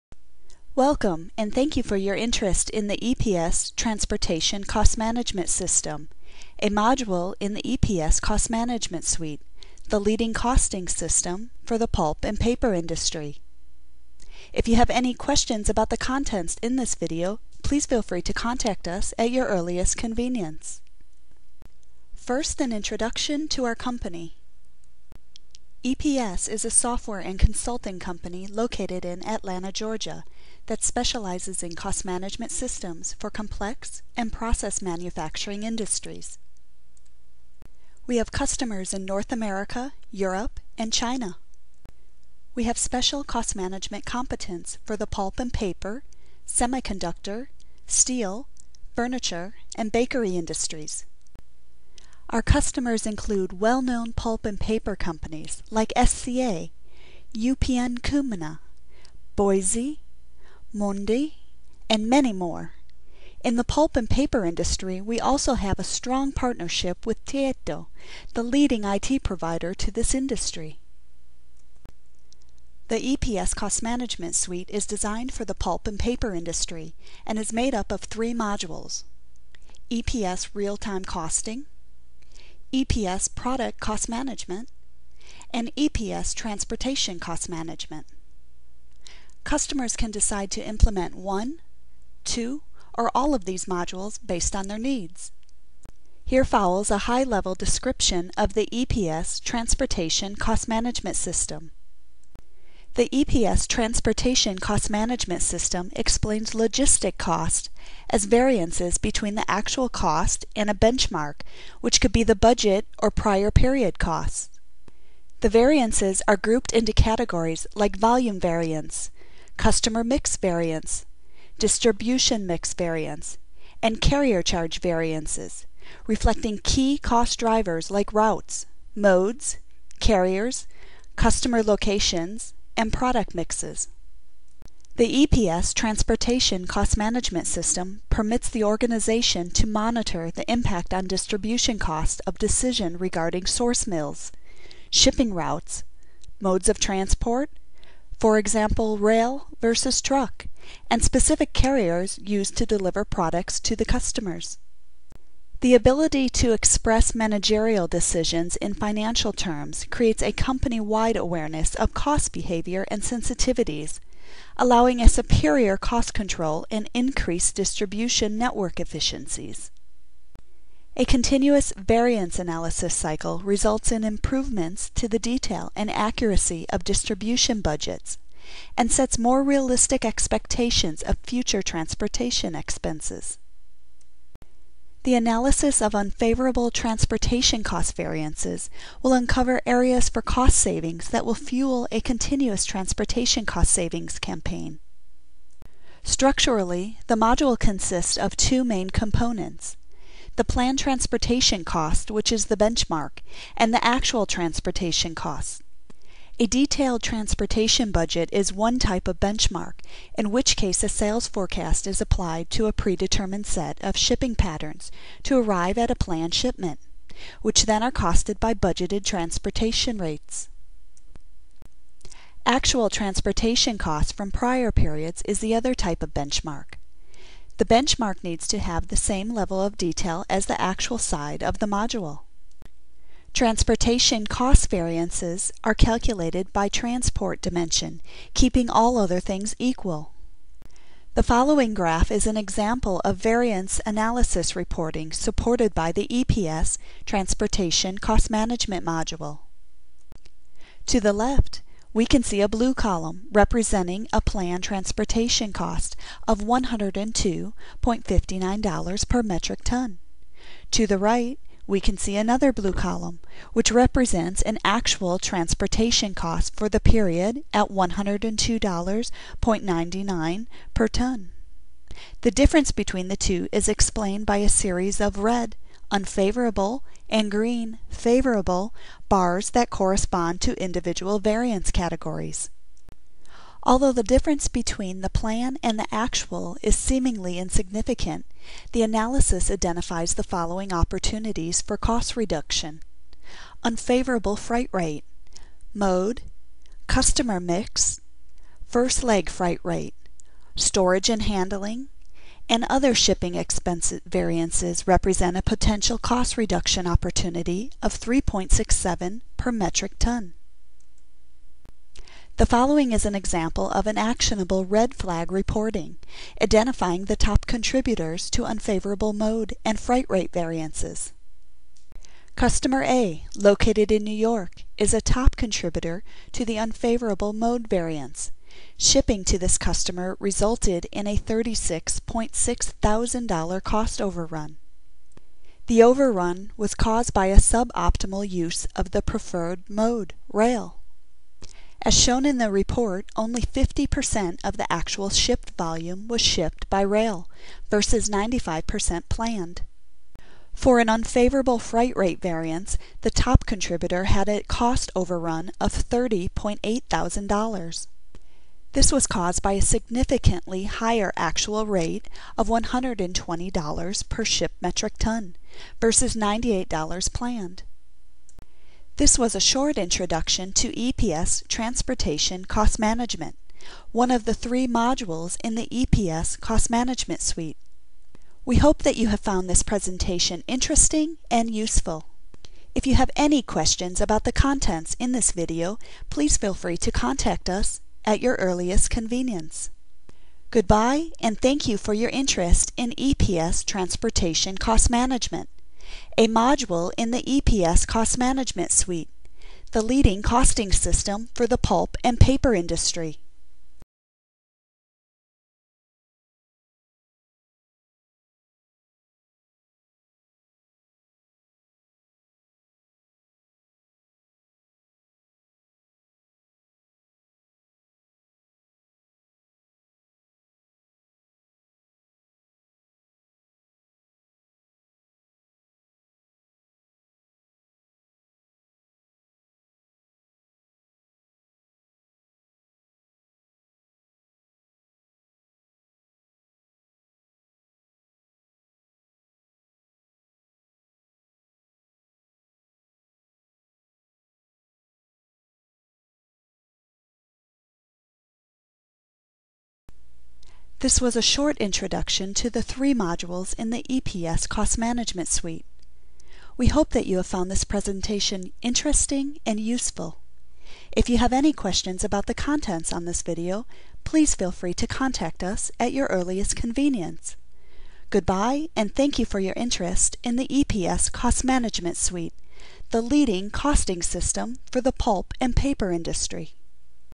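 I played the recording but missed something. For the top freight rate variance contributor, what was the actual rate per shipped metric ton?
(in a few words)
$120.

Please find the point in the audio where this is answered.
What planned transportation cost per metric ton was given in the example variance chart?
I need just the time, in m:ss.
4:16.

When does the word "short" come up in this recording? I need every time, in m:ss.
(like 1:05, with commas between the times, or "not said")
6:09, 7:31.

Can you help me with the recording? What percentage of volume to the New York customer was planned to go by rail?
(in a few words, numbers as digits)
95%.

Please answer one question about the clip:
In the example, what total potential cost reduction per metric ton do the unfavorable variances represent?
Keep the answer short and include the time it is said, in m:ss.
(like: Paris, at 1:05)
3.67, at 5:07.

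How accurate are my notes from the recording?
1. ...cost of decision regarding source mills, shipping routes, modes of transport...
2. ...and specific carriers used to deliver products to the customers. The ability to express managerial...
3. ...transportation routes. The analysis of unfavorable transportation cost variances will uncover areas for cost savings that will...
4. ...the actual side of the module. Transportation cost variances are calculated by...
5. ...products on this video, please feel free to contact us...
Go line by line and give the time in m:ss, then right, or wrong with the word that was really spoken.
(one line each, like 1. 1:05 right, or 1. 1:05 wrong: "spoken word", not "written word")
1. 2:21 right
2. 2:30 right
3. 3:01 wrong: "expenses", not "routes"
4. 3:50 right
5. 7:42 wrong: "contents", not "products".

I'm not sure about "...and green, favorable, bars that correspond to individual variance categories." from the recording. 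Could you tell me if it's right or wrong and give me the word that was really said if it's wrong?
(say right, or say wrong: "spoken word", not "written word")
right.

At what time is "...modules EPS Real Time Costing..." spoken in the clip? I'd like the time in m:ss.
1:18.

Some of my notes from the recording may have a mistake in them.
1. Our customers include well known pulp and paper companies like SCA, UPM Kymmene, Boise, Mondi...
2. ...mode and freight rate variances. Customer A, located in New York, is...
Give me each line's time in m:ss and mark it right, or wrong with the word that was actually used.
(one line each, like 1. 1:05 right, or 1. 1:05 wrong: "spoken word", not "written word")
1. 0:52 right
2. 5:19 right.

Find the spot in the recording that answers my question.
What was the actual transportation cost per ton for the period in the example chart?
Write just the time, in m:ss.
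4:27.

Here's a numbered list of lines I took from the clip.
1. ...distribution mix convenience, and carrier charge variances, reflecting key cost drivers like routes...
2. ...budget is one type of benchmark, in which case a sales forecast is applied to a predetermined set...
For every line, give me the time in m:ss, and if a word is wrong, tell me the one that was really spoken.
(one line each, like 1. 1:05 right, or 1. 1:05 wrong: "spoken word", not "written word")
1. 2:01 wrong: "variance", not "convenience"
2. 3:27 right.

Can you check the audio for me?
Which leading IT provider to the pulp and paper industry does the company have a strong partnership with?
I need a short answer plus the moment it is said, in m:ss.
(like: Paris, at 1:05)
Tieto, at 1:07.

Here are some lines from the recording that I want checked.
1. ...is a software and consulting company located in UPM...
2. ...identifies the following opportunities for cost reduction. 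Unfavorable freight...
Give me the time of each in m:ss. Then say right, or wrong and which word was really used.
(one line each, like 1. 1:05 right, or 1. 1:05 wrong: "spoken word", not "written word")
1. 0:26 wrong: "Atlanta", not "UPM"
2. 4:49 right.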